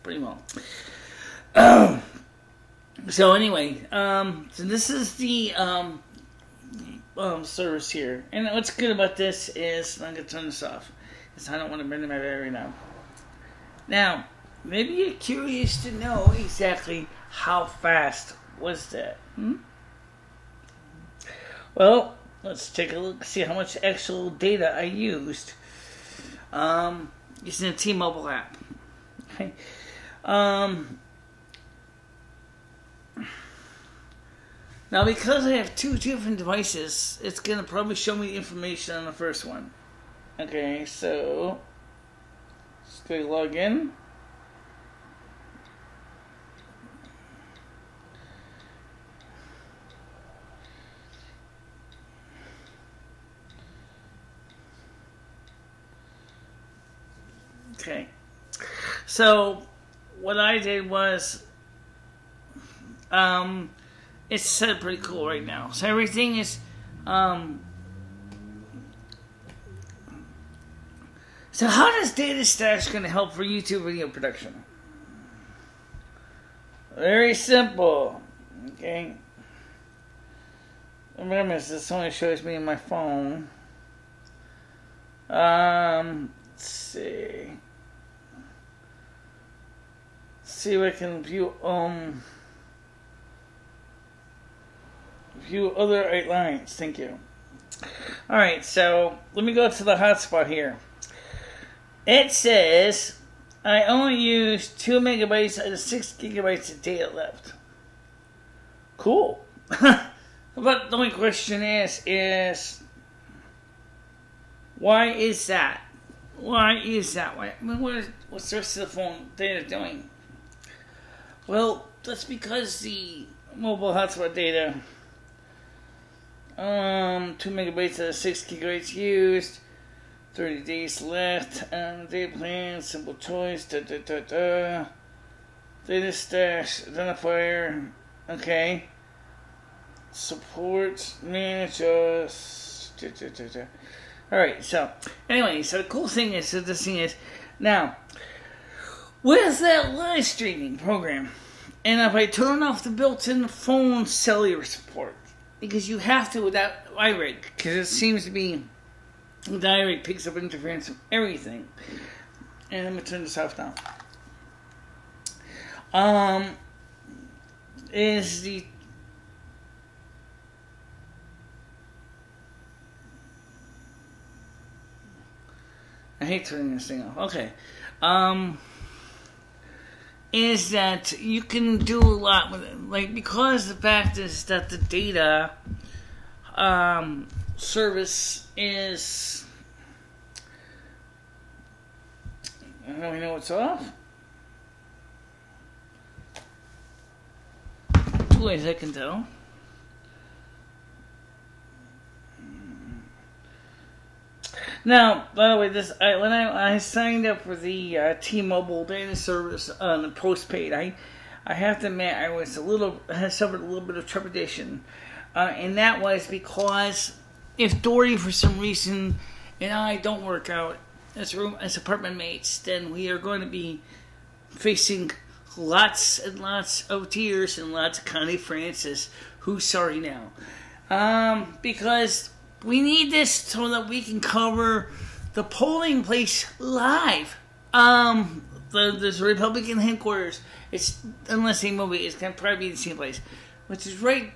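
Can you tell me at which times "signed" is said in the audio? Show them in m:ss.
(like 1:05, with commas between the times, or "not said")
3:26.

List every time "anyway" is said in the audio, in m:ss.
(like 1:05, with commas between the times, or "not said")
0:03, 2:25.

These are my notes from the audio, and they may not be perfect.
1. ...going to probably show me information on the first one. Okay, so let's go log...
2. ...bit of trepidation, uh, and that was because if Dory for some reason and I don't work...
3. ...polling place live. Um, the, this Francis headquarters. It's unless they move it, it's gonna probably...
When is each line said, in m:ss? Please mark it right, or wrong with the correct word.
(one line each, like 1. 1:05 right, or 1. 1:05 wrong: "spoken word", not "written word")
1. 0:37 right
2. 3:33 right
3. 3:55 wrong: "Republican", not "Francis".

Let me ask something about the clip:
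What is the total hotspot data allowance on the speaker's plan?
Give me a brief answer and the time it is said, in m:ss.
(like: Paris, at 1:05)
6 gigabytes, at 2:08.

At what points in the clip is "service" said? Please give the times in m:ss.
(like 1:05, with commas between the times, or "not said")
0:07, 3:07, 3:29.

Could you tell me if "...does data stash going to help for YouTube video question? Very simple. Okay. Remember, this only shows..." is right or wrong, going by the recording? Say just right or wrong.
wrong.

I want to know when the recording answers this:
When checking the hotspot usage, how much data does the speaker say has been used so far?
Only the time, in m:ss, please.
1:44.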